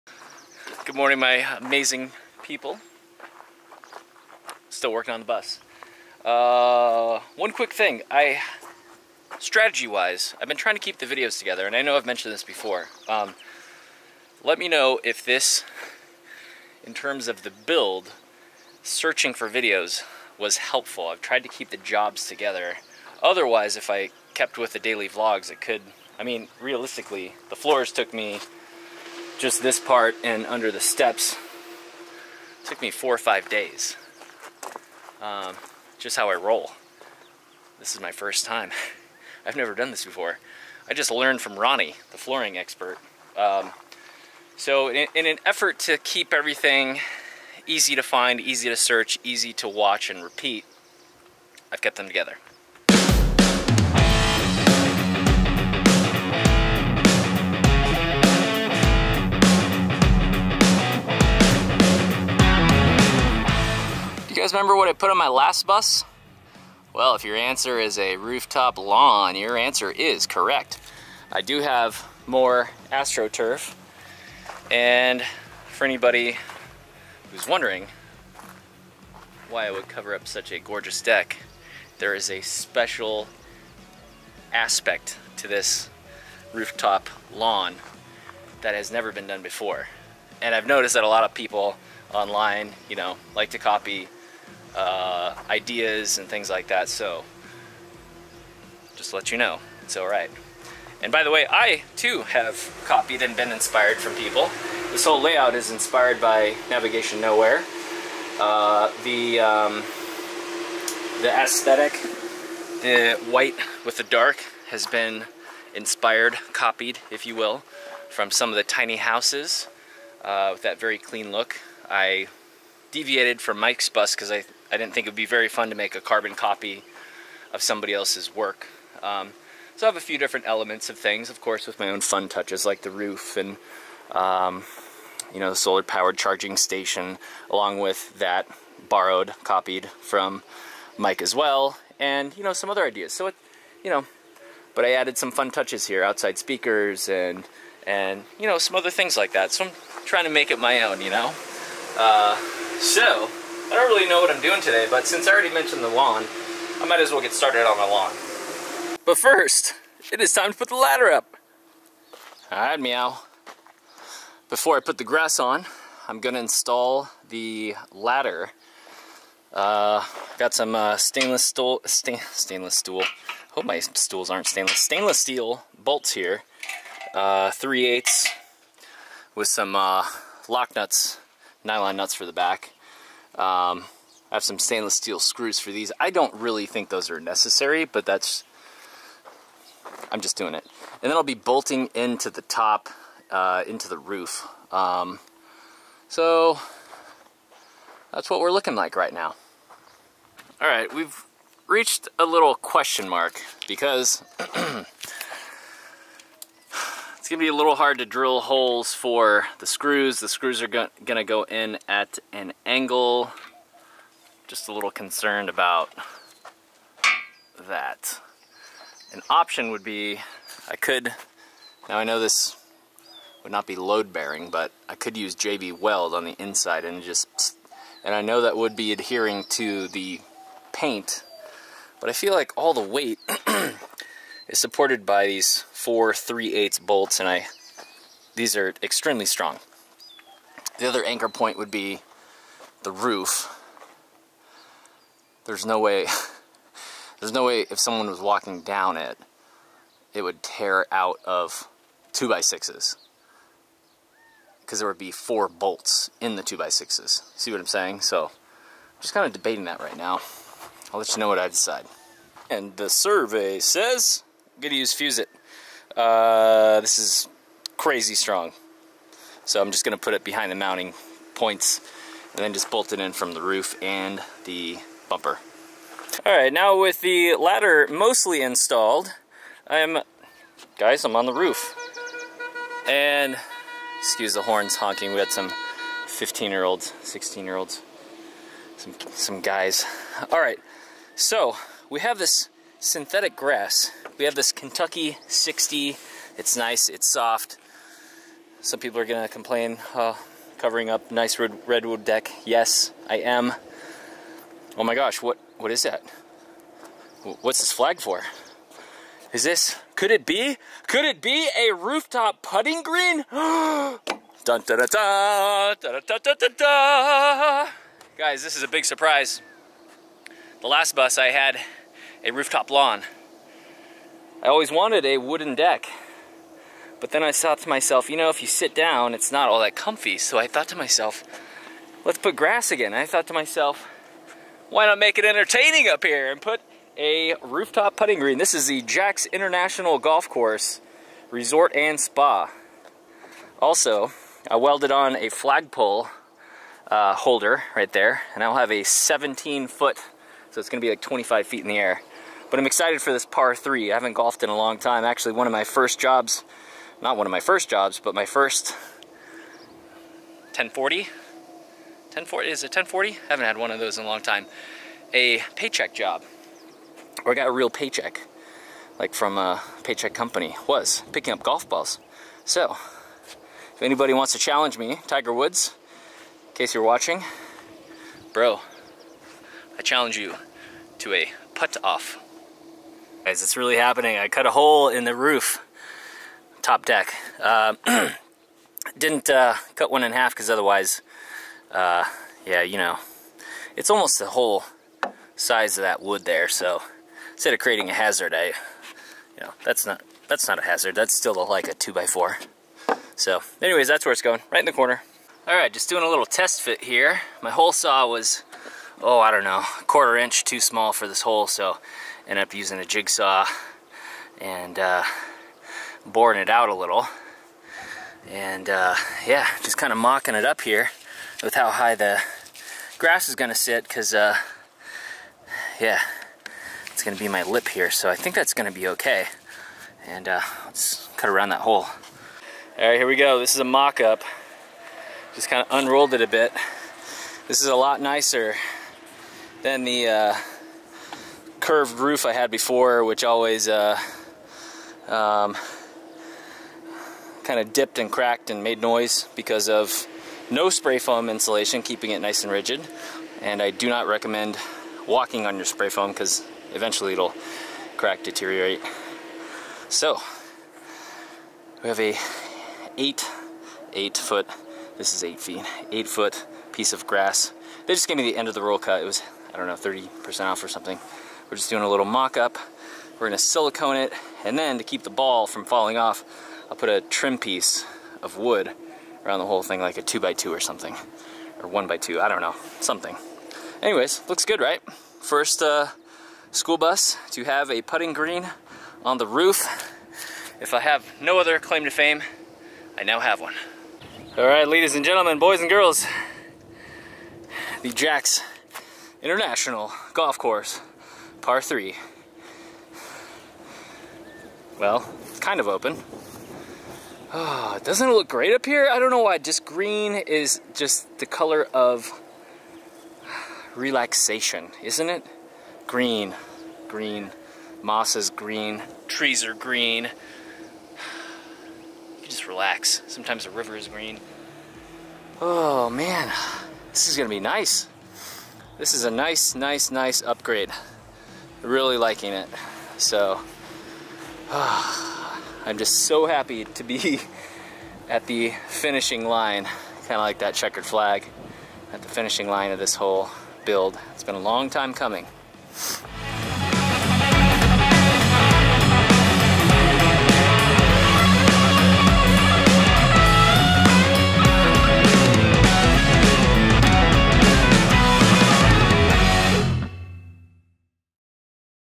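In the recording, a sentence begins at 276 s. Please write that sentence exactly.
All right, now with the ladder mostly installed, I'm, guys, I'm on the roof.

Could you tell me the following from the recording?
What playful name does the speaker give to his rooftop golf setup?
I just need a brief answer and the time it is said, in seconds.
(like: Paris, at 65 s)
Jax International Golf Course Resort and Spa, at 338 s.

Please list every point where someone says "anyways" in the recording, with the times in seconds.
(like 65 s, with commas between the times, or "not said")
403 s, 483 s.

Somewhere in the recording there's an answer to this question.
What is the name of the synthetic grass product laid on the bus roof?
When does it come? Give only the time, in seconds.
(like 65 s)
294 s.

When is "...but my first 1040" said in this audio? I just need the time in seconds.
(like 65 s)
358 s.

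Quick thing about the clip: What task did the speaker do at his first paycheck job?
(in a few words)
picking up golf balls.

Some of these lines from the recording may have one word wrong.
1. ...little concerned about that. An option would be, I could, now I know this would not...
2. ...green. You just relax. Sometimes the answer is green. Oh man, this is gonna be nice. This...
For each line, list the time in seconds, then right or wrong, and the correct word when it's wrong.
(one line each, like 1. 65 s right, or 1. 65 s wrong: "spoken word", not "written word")
1. 214 s right
2. 519 s wrong: "river", not "answer".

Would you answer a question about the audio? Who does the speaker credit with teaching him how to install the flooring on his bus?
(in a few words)
Ronnie.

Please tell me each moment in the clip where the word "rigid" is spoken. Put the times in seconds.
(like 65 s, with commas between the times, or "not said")
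452 s.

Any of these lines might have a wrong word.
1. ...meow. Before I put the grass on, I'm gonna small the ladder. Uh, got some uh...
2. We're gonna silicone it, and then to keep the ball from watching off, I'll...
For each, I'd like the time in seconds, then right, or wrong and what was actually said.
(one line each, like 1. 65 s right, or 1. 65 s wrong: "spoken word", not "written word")
1. 162 s wrong: "install", not "small"
2. 473 s wrong: "falling", not "watching".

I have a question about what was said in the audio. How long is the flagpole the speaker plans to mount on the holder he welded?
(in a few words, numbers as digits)
17 feet.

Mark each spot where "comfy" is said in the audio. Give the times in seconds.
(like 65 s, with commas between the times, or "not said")
329 s.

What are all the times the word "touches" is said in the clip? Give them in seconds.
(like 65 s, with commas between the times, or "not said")
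132 s, 145 s.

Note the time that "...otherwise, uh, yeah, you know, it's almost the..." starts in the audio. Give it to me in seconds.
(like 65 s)
390 s.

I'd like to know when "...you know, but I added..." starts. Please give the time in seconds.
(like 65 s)
143 s.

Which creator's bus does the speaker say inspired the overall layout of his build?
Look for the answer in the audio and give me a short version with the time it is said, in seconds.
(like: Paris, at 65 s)
Navigation Nowhere, at 106 s.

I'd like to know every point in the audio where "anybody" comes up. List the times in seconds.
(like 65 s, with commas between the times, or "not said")
75 s, 373 s.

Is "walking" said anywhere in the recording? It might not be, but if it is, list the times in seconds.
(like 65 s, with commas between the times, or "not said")
248 s, 455 s.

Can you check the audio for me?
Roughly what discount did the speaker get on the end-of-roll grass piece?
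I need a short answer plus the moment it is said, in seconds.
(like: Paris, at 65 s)
30%, at 469 s.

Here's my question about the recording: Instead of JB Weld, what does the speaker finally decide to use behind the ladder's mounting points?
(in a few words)
fuse it.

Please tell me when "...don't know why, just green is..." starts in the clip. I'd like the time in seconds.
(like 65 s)
508 s.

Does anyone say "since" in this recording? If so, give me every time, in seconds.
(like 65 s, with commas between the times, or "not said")
155 s.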